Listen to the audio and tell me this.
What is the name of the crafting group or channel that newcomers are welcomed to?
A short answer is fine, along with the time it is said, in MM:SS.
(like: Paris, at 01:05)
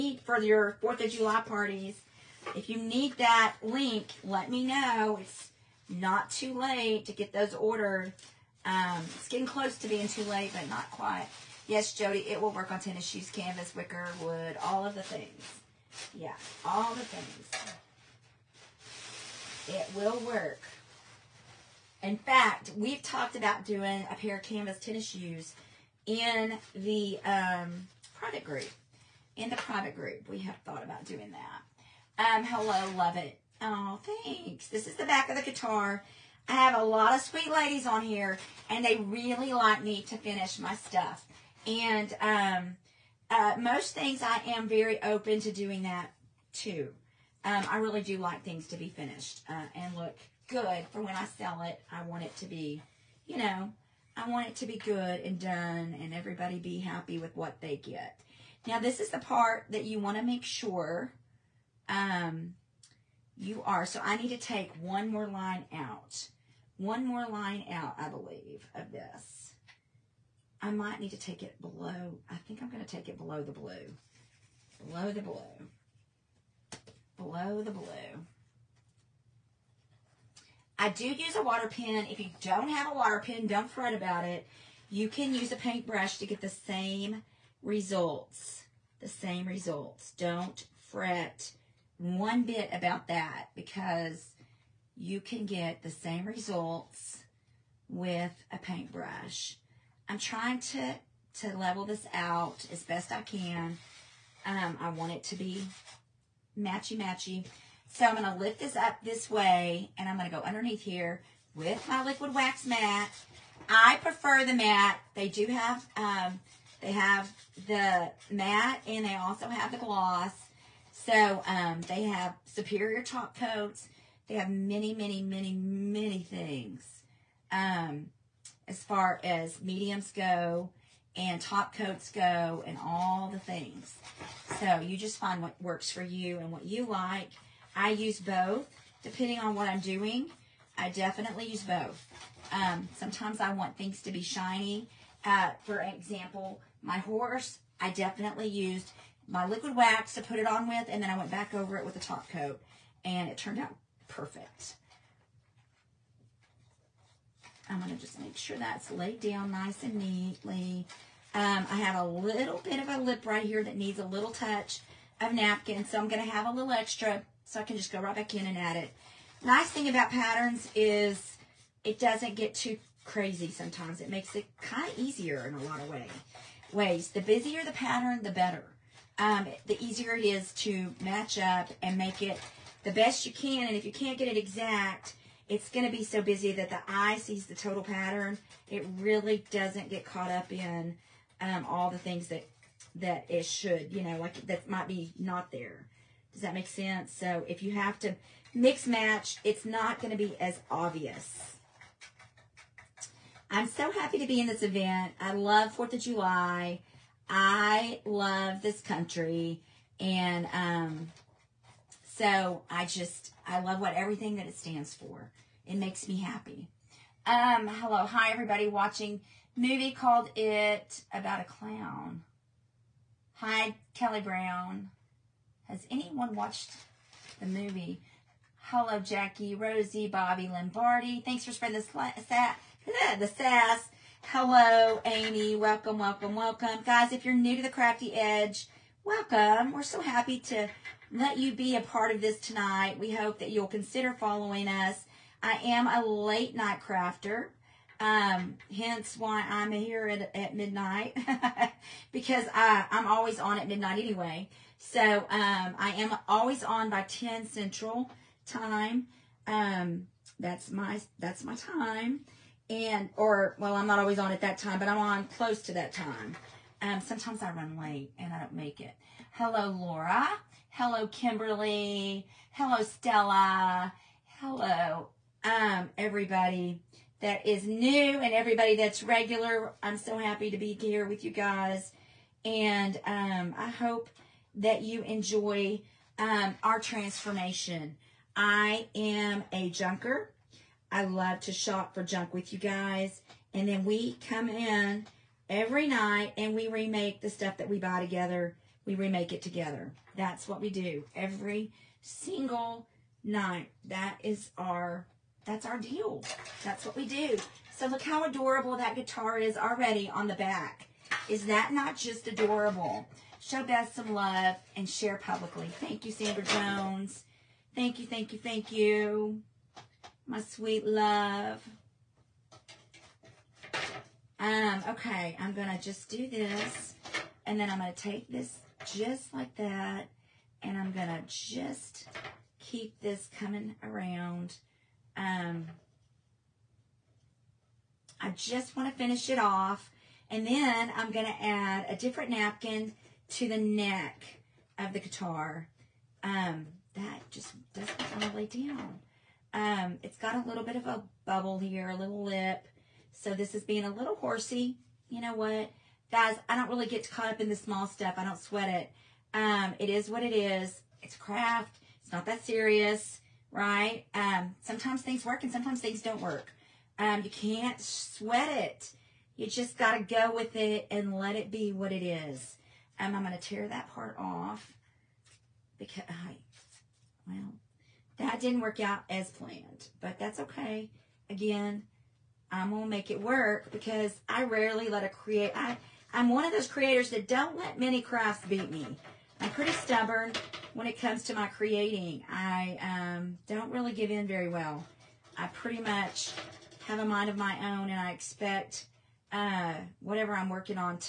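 Crafty Edge, at 03:57.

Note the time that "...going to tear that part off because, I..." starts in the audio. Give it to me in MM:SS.
06:13.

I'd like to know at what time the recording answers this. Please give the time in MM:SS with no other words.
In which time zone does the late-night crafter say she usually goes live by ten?
04:17.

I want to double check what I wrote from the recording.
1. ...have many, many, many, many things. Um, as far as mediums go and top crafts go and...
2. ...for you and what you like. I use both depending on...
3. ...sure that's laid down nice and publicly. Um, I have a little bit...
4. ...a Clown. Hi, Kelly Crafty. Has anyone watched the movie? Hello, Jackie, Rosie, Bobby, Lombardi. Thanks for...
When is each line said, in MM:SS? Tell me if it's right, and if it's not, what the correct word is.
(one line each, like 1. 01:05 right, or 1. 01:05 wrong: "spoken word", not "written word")
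1. 02:04 wrong: "coats", not "crafts"
2. 02:15 right
3. 02:38 wrong: "neatly", not "publicly"
4. 03:41 wrong: "Brown", not "Crafty".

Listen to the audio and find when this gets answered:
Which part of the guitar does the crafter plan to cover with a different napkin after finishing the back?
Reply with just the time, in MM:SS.
05:43.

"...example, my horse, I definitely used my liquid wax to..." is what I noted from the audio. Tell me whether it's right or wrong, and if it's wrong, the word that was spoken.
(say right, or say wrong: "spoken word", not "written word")
right.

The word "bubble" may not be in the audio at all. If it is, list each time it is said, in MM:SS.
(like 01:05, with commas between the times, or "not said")
05:51.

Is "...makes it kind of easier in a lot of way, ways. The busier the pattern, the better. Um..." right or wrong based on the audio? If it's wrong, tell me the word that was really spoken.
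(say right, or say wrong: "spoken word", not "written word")
right.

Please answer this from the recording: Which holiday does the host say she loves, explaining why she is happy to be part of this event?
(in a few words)
4th of July.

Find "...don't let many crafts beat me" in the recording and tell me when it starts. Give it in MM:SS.
06:27.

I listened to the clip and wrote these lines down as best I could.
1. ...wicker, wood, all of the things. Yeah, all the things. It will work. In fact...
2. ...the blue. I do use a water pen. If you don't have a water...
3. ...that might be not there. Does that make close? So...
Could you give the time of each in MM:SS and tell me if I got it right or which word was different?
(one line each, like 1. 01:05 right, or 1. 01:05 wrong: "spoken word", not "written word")
1. 00:13 right
2. 01:17 right
3. 03:14 wrong: "sense", not "close".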